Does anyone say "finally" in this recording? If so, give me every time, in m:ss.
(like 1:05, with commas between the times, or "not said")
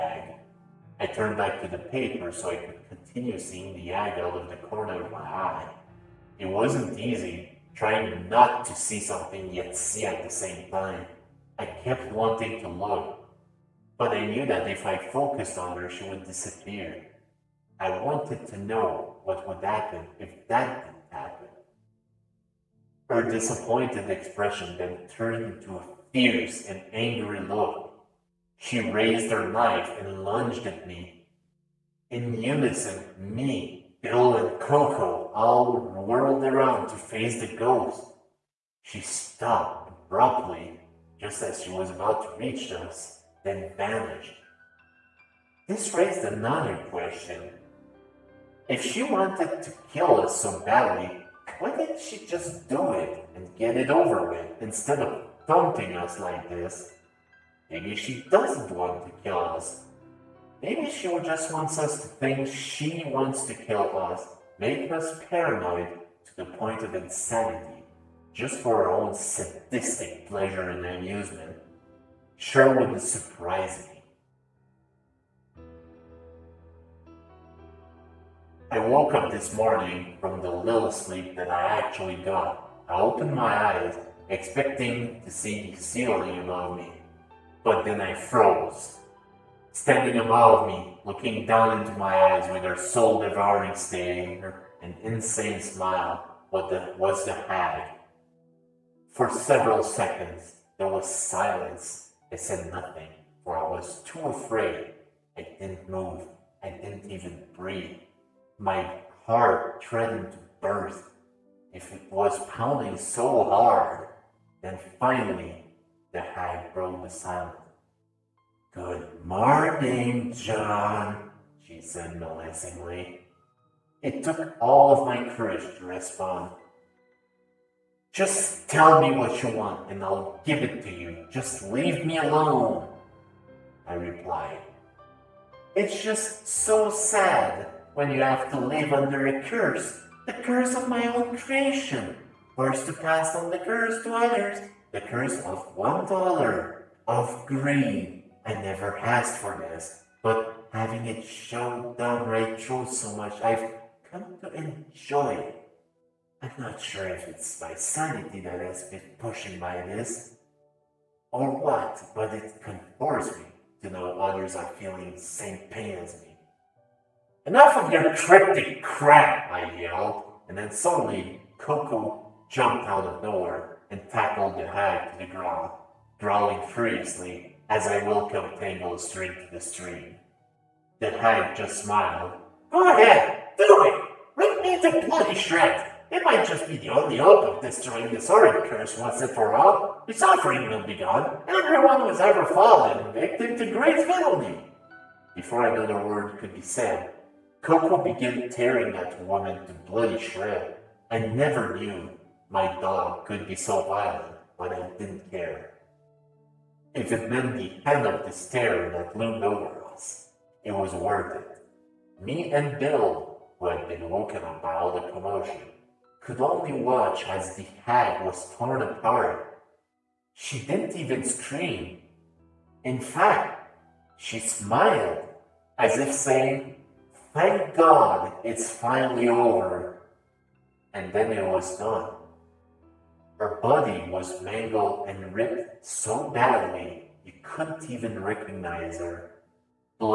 1:54, 3:48.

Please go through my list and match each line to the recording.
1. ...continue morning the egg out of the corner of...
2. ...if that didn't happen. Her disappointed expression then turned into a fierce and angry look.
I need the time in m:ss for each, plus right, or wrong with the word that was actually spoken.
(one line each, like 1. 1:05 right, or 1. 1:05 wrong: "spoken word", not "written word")
1. 0:02 wrong: "seeing", not "morning"
2. 0:20 right.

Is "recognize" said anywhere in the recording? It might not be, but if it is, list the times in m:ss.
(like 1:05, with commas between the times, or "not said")
3:58.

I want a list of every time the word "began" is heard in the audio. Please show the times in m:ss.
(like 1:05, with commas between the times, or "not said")
3:18.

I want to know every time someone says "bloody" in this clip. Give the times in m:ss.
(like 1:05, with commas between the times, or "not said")
3:05, 3:19.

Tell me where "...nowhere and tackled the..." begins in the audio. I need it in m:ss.
2:53.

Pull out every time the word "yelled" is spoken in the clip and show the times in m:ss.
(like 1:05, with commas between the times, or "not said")
2:49.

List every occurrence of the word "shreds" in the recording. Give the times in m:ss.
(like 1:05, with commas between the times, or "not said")
3:05, 3:20.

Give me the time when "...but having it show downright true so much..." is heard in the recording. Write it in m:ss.
2:30.